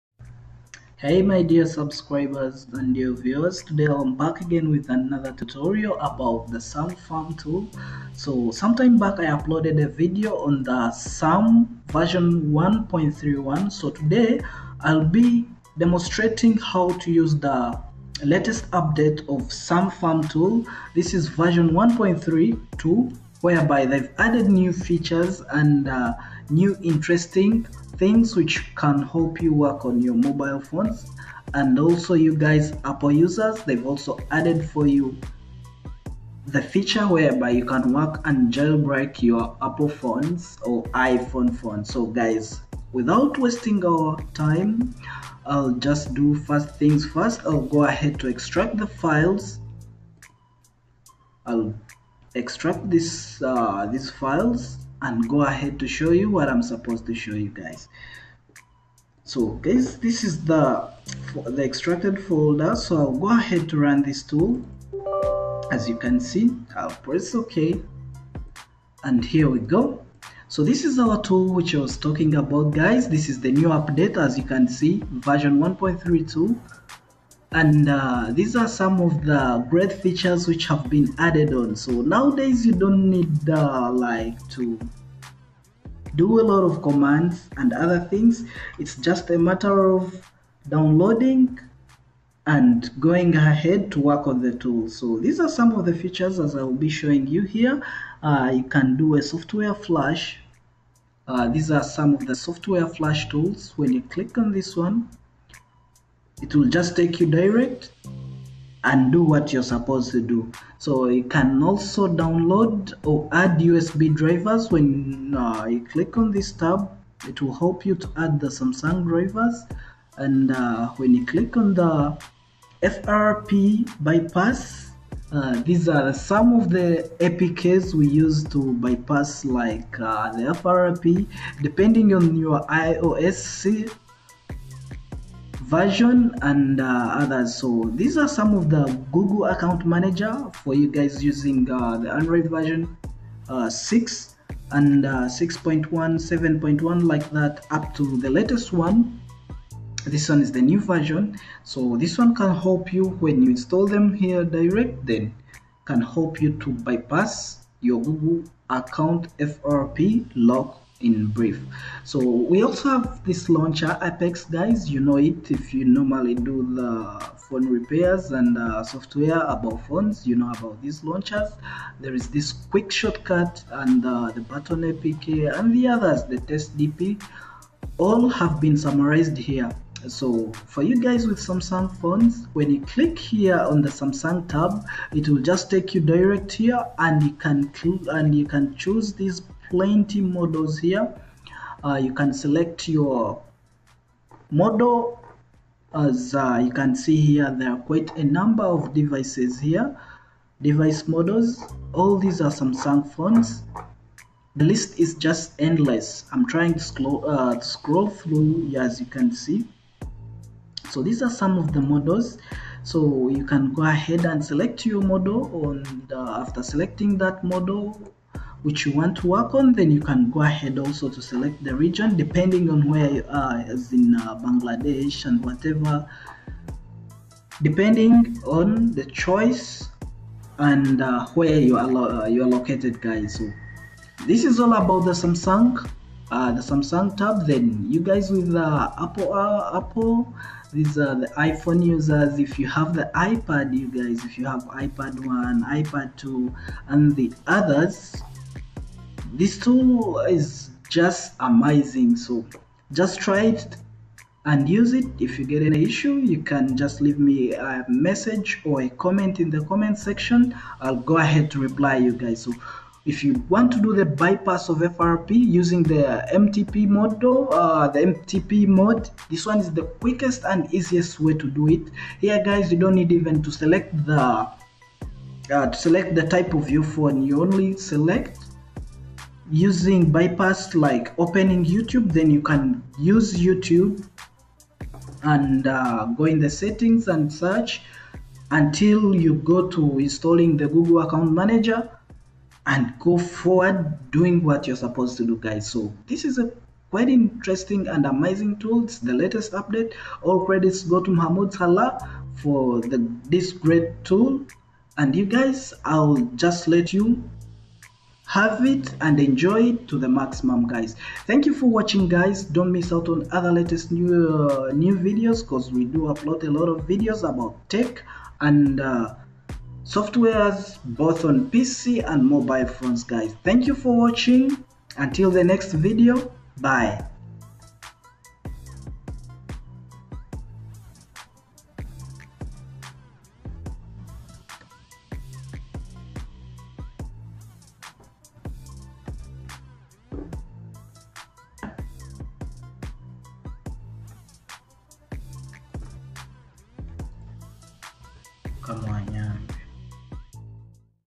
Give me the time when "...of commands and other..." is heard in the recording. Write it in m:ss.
1:26.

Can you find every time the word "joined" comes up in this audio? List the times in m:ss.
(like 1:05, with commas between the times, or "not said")
not said.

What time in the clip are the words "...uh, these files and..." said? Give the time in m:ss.
0:53.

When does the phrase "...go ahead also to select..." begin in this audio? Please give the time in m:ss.
3:40.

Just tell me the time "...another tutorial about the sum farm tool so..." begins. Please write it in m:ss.
0:04.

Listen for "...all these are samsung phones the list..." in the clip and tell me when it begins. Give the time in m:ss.
3:22.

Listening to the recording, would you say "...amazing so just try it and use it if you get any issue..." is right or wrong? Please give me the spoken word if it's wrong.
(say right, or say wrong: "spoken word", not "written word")
right.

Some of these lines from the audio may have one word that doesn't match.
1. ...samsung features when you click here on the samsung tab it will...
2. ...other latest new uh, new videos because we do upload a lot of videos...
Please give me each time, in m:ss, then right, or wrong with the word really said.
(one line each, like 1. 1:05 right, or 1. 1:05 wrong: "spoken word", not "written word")
1. 3:01 wrong: "phones", not "features"
2. 5:13 right.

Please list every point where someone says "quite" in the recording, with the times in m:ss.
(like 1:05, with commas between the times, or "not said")
3:17, 4:56.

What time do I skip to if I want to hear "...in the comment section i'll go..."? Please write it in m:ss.
4:19.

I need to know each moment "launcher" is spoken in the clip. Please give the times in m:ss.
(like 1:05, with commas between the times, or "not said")
2:43, 2:51.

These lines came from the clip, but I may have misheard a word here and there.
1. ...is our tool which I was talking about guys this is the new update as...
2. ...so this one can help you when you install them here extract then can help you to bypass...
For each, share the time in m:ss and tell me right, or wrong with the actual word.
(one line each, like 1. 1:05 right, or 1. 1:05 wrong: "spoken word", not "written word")
1. 1:10 right
2. 2:31 wrong: "direct", not "extract".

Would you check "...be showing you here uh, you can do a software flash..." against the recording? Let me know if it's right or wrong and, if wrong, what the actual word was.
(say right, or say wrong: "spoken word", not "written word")
right.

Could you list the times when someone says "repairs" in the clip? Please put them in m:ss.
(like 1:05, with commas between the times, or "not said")
2:47.